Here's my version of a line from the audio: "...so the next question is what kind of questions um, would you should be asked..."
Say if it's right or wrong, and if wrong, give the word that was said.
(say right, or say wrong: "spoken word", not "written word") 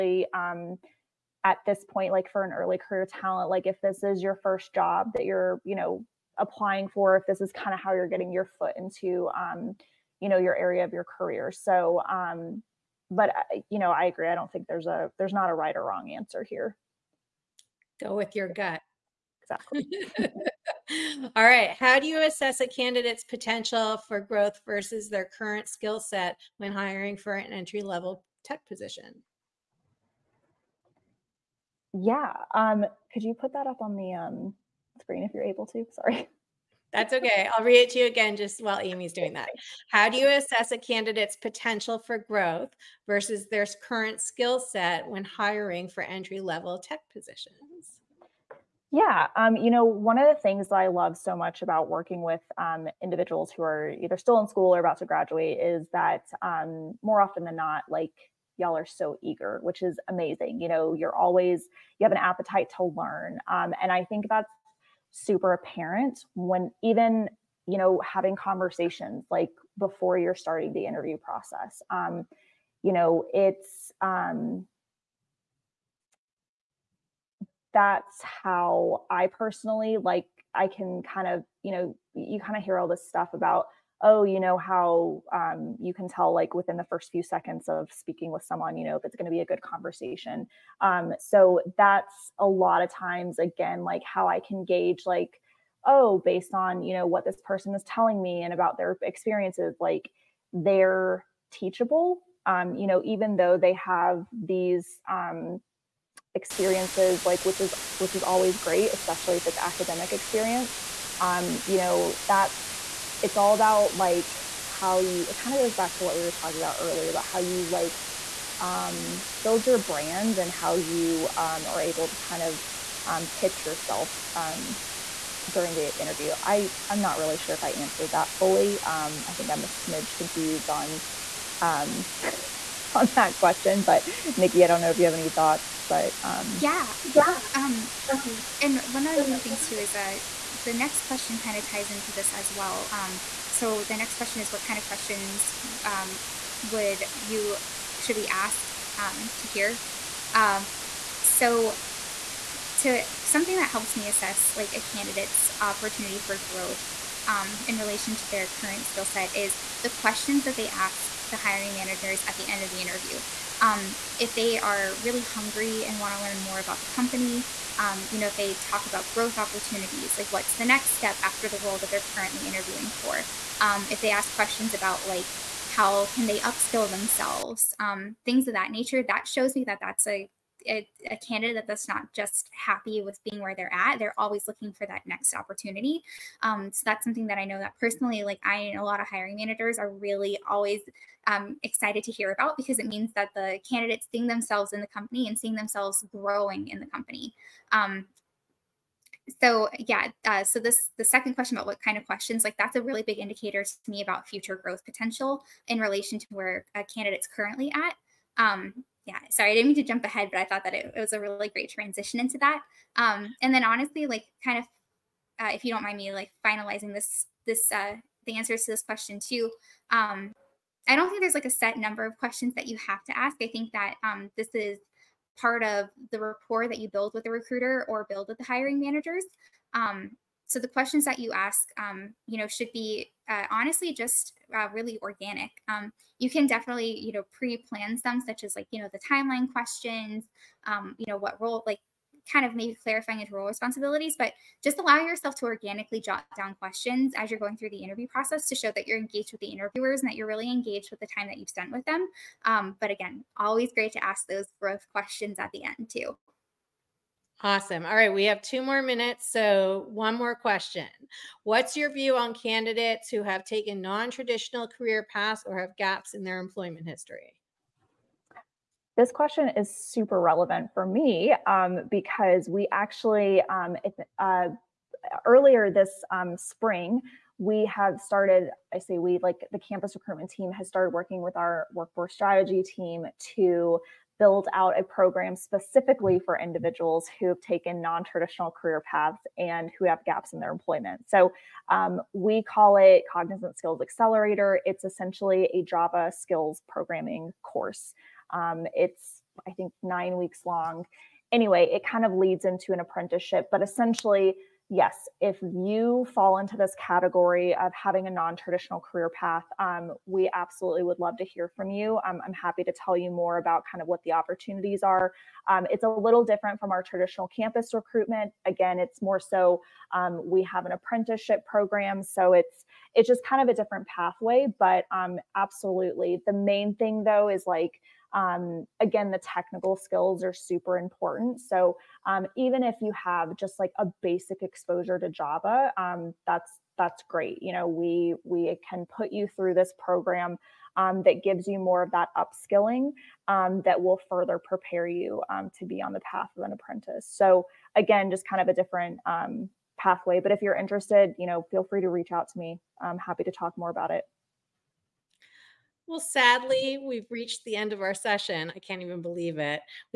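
right.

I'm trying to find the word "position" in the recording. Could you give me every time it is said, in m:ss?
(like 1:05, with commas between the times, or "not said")
0:28, 0:47.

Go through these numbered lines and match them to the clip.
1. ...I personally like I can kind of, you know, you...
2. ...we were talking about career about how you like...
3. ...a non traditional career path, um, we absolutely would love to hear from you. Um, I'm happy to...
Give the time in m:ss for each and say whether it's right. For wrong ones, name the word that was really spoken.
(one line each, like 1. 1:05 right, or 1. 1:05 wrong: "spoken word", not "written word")
1. 1:19 right
2. 1:56 wrong: "earlier", not "career"
3. 5:08 right.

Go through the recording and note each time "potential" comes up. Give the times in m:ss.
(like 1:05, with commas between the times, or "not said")
0:23, 0:41, 3:24.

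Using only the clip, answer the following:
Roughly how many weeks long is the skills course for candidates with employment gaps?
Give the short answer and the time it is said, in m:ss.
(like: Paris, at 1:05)
9 weeks, at 4:59.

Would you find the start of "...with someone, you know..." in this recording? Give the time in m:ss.
1:28.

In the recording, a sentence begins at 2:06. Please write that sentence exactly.
I I'm not really sure if I answered that fully.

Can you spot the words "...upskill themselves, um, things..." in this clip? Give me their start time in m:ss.
2:56.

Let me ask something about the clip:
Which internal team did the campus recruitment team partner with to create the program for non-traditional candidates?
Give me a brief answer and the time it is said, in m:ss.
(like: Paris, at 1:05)
workforce strategy team, at 4:41.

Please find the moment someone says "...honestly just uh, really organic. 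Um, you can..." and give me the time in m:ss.
3:53.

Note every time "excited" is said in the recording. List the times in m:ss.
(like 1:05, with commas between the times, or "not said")
3:11.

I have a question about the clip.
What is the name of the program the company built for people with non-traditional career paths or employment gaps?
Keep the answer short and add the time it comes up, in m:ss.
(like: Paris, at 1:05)
Cognizant Skills Accelerator, at 4:53.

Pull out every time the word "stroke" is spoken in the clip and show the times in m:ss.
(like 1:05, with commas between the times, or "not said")
not said.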